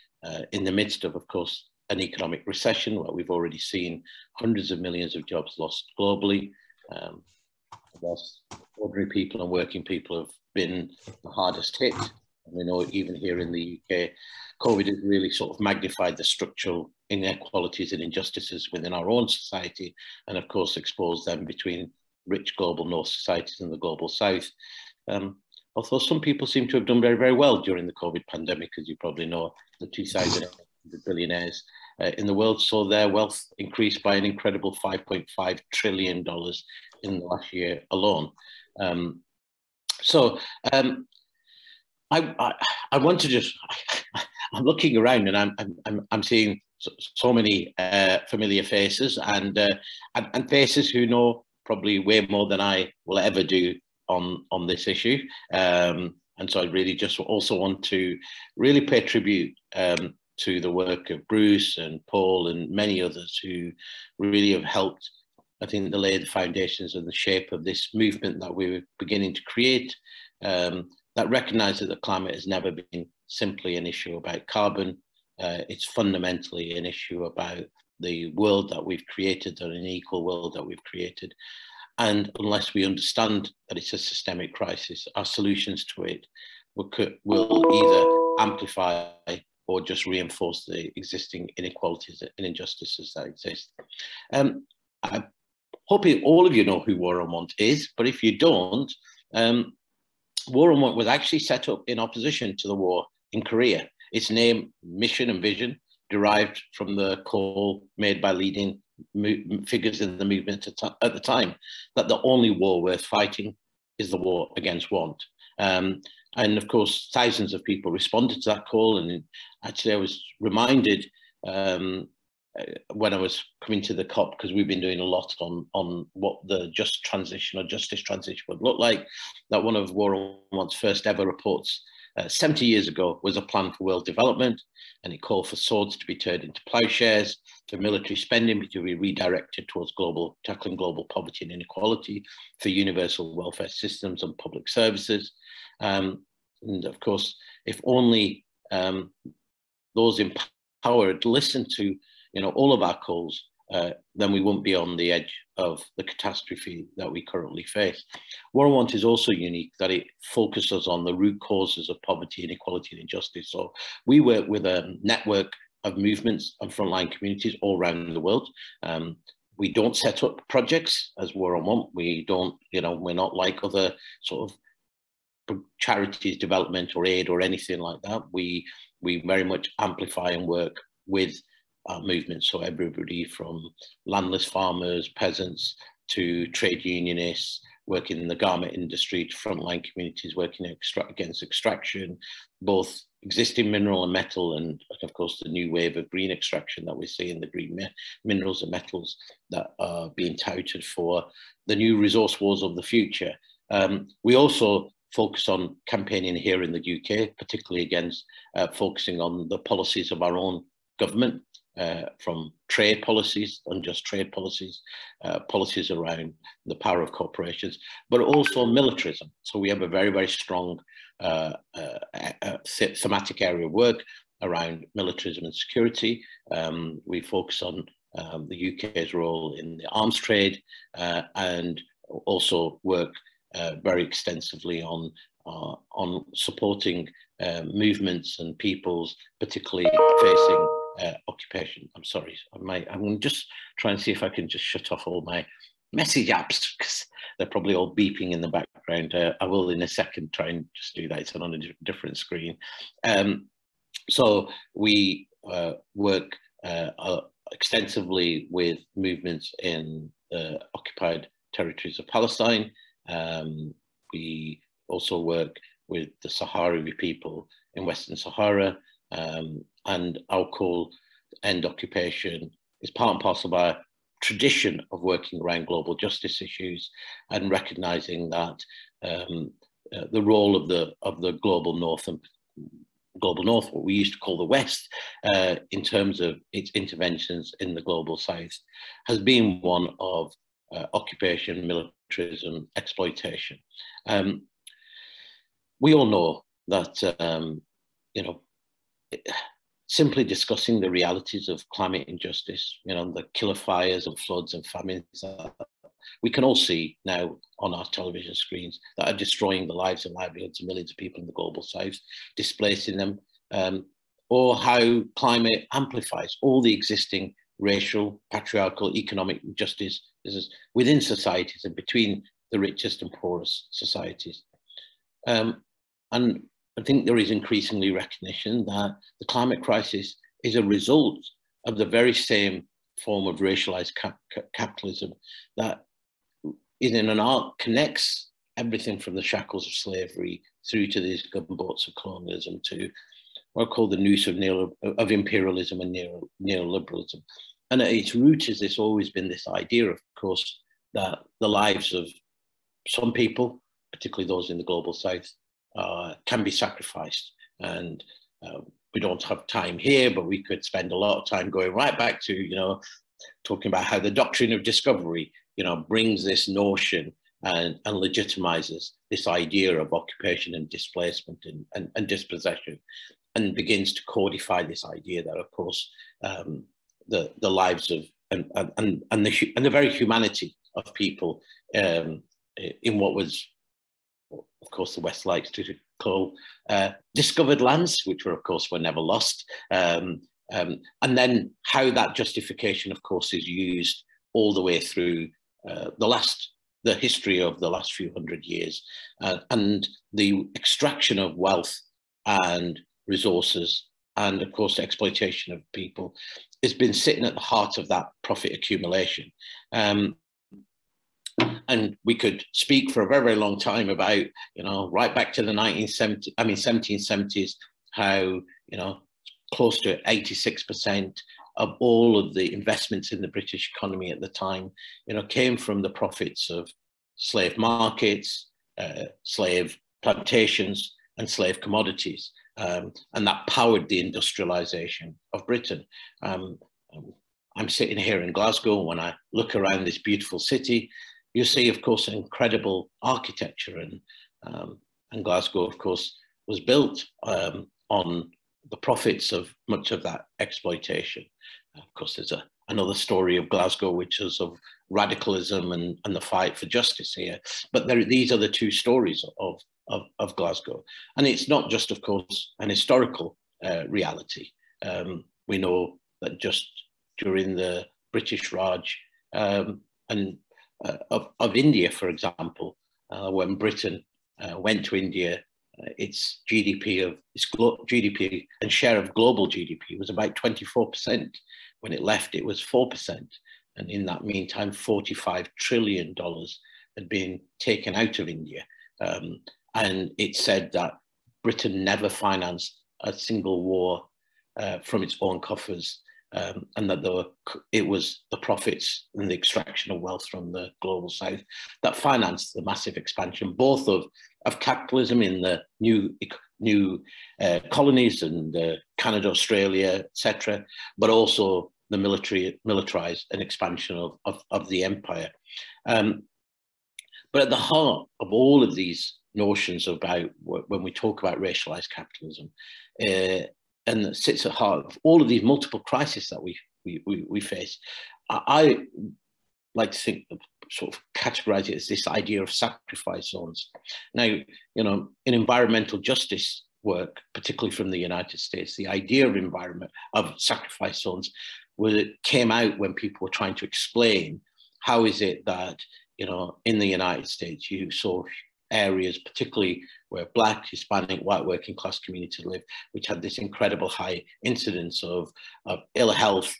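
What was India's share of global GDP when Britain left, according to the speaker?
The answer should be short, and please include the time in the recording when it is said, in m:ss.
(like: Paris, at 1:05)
4%, at 8:02.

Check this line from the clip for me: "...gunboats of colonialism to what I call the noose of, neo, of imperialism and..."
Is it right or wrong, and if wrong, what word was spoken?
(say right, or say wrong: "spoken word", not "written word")
right.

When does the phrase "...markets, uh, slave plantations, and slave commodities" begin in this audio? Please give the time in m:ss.
7:07.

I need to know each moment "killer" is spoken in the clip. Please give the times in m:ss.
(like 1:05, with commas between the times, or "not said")
5:03.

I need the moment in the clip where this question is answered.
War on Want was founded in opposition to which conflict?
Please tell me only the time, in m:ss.
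1:42.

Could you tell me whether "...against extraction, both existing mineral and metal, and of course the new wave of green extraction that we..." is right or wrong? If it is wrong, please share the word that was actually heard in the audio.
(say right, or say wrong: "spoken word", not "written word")
right.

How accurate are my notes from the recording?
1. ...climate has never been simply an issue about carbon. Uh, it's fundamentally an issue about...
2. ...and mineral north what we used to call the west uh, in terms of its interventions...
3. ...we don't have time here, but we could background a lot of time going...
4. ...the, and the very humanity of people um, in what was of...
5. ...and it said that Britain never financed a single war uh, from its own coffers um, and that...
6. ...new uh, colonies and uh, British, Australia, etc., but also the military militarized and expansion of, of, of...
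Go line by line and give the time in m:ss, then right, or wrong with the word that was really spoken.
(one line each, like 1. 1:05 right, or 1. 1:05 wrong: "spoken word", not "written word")
1. 1:12 right
2. 4:42 wrong: "global", not "mineral"
3. 5:58 wrong: "spend", not "background"
4. 6:19 right
5. 8:09 right
6. 8:26 wrong: "Canada", not "British".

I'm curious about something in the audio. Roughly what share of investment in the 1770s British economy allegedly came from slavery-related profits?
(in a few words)
86%.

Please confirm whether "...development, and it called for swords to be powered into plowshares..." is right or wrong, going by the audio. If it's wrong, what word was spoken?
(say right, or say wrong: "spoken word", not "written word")
wrong: "turned", not "powered".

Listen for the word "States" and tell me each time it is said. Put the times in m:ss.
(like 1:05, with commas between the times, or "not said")
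8:58, 9:07.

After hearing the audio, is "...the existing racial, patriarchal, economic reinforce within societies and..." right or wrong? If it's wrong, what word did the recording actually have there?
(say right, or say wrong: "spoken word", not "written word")
wrong: "injustice", not "reinforce".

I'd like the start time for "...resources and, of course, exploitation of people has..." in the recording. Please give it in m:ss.
6:43.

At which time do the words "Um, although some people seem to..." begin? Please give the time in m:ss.
0:25.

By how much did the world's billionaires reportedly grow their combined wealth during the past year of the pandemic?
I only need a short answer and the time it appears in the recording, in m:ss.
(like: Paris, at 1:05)
$5.5 trillion, at 0:34.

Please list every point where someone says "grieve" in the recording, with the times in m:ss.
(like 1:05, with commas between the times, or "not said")
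not said.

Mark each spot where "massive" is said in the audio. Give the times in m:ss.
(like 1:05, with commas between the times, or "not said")
8:22.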